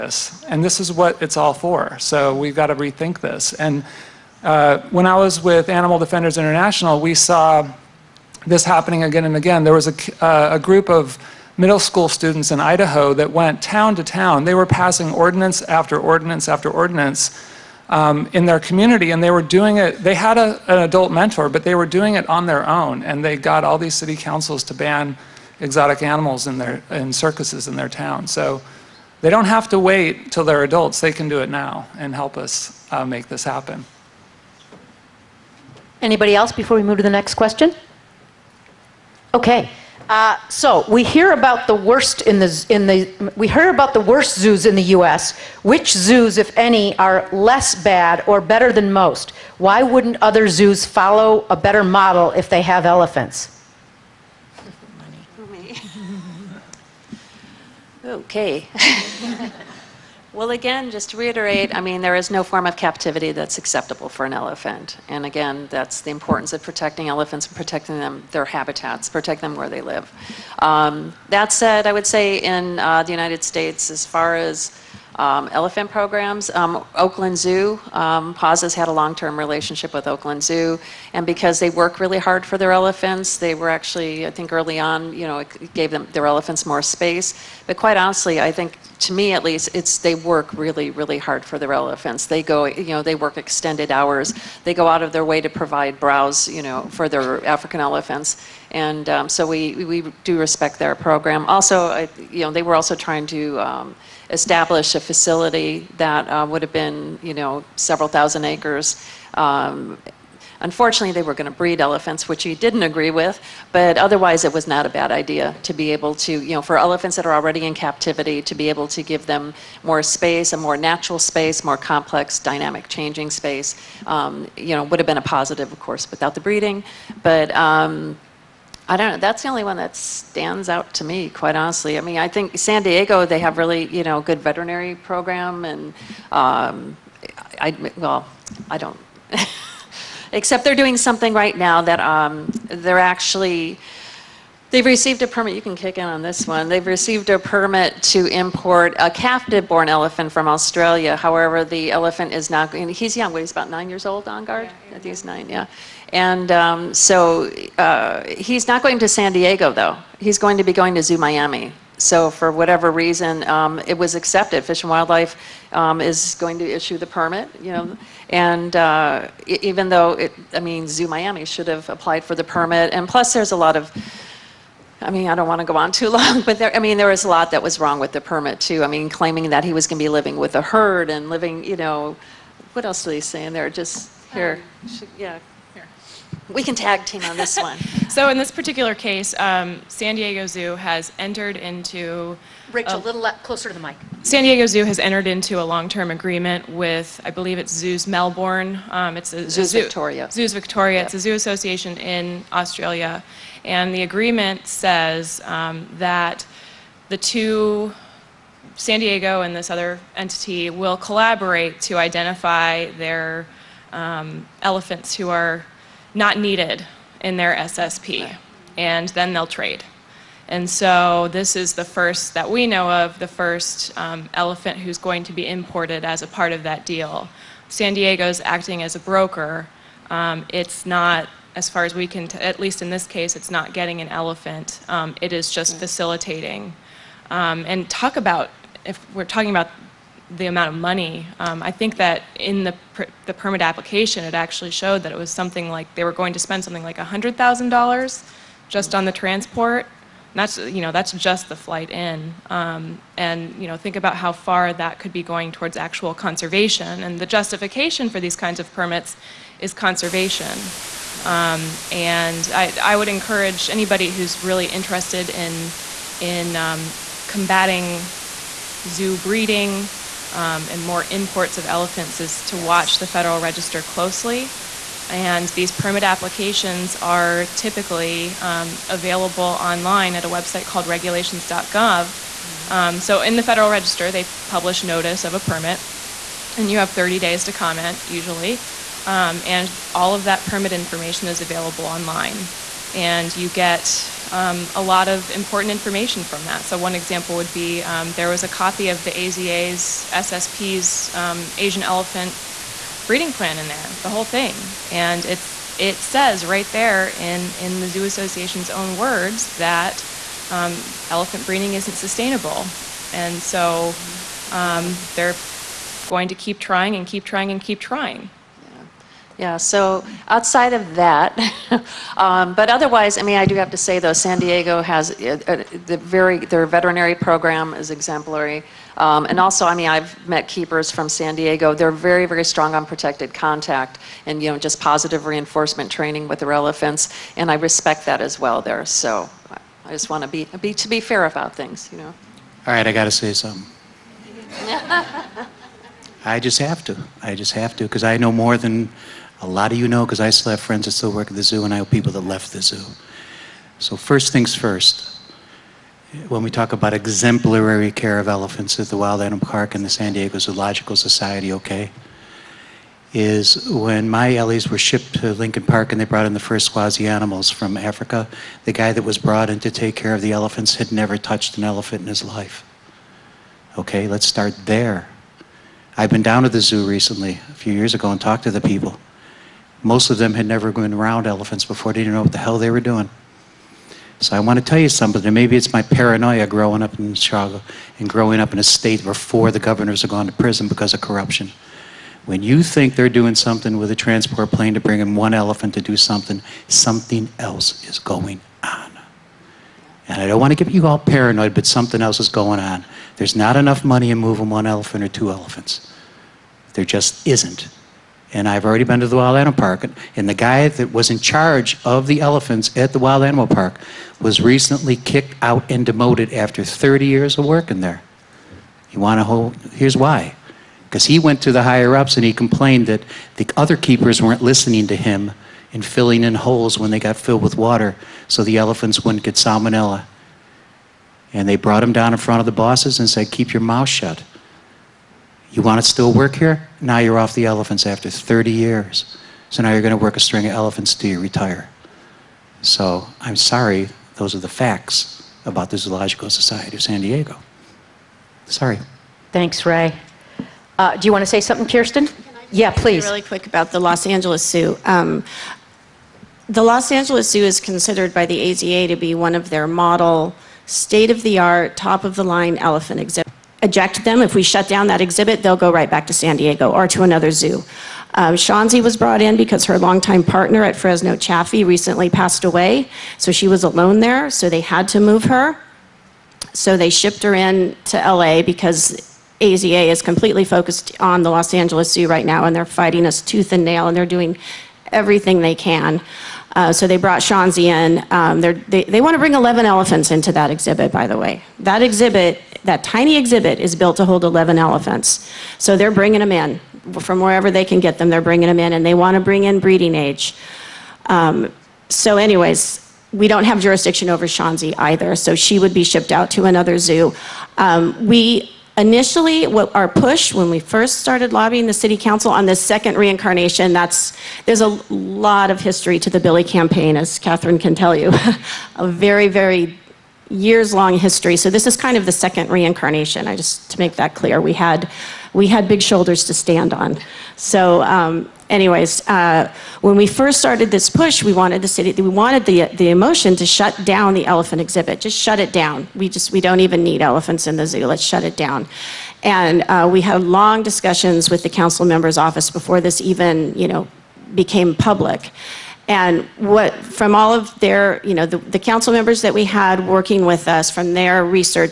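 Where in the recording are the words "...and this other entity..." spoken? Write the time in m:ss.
3:29.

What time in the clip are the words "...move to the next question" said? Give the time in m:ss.
0:36.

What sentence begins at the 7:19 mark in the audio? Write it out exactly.
So now you're going to work a string of elephants till you retire.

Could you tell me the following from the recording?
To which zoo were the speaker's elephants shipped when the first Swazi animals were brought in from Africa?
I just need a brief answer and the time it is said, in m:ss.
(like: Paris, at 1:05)
Lincoln Park, at 6:05.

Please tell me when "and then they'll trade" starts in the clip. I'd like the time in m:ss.
3:38.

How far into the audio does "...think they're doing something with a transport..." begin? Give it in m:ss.
6:32.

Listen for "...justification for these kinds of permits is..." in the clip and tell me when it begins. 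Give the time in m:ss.
4:17.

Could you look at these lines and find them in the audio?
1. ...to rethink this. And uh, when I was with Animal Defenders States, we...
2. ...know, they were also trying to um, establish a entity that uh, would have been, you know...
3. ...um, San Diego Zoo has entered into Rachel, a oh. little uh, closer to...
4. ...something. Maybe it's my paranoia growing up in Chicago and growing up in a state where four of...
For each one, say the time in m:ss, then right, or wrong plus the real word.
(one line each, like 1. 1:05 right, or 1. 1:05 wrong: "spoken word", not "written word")
1. 0:02 wrong: "International", not "States"
2. 1:42 wrong: "facility", not "entity"
3. 3:09 right
4. 6:24 right.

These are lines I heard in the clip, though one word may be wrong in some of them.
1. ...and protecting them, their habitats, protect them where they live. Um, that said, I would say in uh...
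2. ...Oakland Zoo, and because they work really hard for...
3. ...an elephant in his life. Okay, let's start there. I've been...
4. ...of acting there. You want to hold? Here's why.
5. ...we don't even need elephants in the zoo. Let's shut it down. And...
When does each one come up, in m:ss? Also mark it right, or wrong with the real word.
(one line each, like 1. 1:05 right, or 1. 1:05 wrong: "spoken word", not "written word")
1. 1:07 right
2. 1:20 right
3. 6:11 right
4. 6:57 wrong: "working", not "acting"
5. 8:56 right.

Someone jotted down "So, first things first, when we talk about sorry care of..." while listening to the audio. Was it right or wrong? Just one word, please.
wrong.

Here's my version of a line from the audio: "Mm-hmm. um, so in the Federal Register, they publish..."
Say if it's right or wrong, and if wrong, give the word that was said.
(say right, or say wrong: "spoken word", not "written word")
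right.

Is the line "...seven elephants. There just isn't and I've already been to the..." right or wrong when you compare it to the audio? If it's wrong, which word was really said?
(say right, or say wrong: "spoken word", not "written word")
wrong: "two", not "seven".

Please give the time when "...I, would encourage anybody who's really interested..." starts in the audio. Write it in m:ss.
4:22.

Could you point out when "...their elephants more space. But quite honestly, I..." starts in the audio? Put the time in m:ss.
1:26.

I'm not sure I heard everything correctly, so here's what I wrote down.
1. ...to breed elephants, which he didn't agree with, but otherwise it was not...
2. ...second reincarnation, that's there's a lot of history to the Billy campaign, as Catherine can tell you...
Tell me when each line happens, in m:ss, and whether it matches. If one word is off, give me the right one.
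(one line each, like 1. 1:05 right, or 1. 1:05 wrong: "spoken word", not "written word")
1. 1:51 right
2. 8:32 right.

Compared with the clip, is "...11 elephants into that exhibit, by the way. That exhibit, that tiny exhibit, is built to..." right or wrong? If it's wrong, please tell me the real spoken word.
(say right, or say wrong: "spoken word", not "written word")
right.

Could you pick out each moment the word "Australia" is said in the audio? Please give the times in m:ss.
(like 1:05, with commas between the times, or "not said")
2:30, 3:22.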